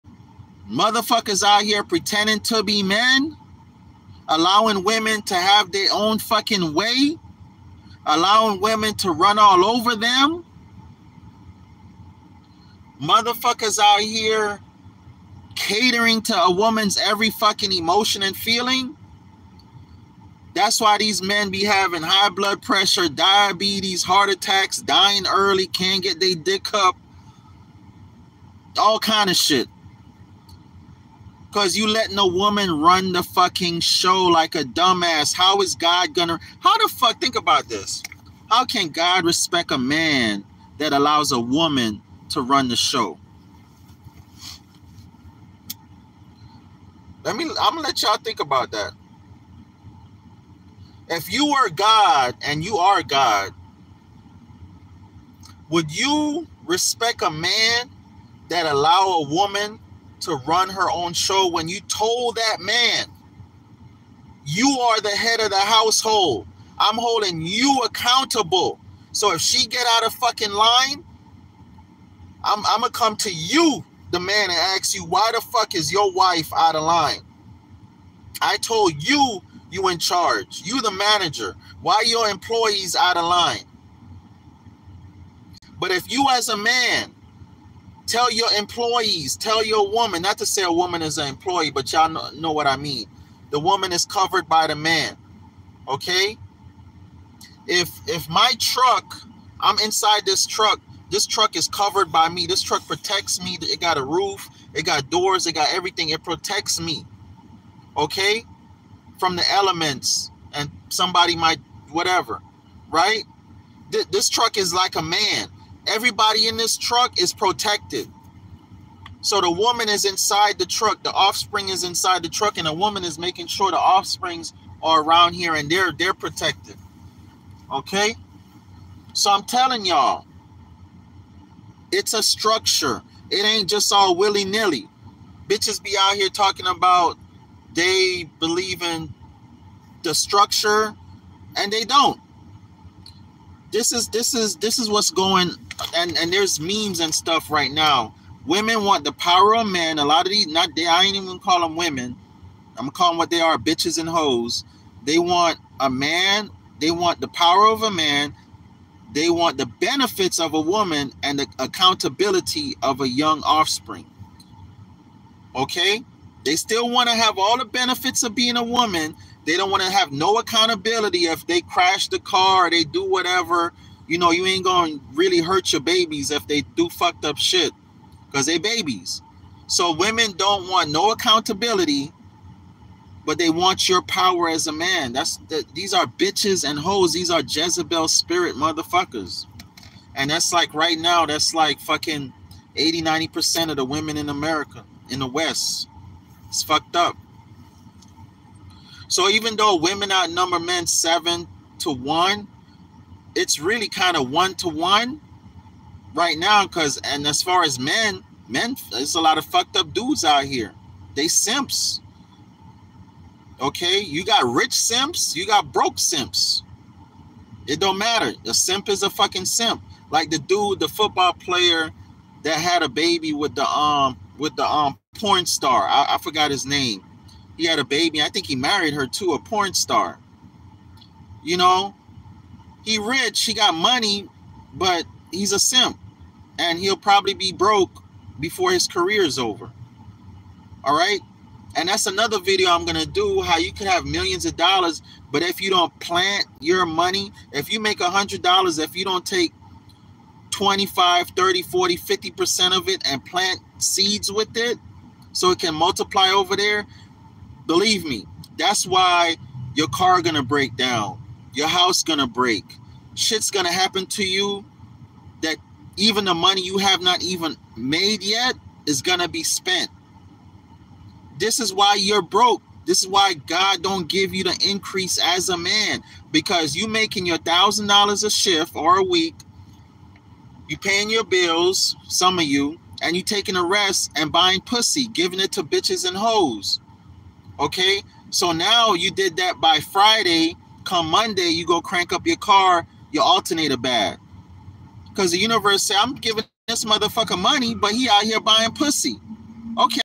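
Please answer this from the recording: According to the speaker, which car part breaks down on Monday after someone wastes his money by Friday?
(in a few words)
alternator.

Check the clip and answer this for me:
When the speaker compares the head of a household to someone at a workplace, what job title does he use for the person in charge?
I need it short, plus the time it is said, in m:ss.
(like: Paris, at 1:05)
manager, at 1:20.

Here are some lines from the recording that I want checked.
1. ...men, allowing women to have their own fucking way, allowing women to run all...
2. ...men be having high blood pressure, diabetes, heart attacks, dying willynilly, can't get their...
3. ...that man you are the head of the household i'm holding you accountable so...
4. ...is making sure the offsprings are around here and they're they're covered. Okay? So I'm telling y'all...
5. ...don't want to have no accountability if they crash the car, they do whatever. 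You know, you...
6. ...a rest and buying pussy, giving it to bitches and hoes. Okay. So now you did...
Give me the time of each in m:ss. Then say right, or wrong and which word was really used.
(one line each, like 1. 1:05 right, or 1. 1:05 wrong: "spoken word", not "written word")
1. 0:02 right
2. 0:21 wrong: "early", not "willynilly"
3. 1:02 right
4. 2:03 wrong: "protected", not "covered"
5. 2:49 right
6. 4:43 right.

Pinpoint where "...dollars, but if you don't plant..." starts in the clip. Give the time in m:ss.
4:04.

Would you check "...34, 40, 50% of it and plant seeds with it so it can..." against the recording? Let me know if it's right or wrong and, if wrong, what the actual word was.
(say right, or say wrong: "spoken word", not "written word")
wrong: "30", not "34".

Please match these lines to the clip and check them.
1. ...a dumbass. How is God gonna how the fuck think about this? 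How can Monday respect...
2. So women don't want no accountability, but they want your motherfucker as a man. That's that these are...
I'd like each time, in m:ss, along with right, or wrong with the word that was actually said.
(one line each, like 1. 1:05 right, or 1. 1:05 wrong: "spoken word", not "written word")
1. 0:34 wrong: "God", not "Monday"
2. 2:59 wrong: "power", not "motherfucker".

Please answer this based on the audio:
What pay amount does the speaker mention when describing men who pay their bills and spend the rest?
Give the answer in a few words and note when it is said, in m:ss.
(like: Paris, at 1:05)
1000 dollars, at 4:37.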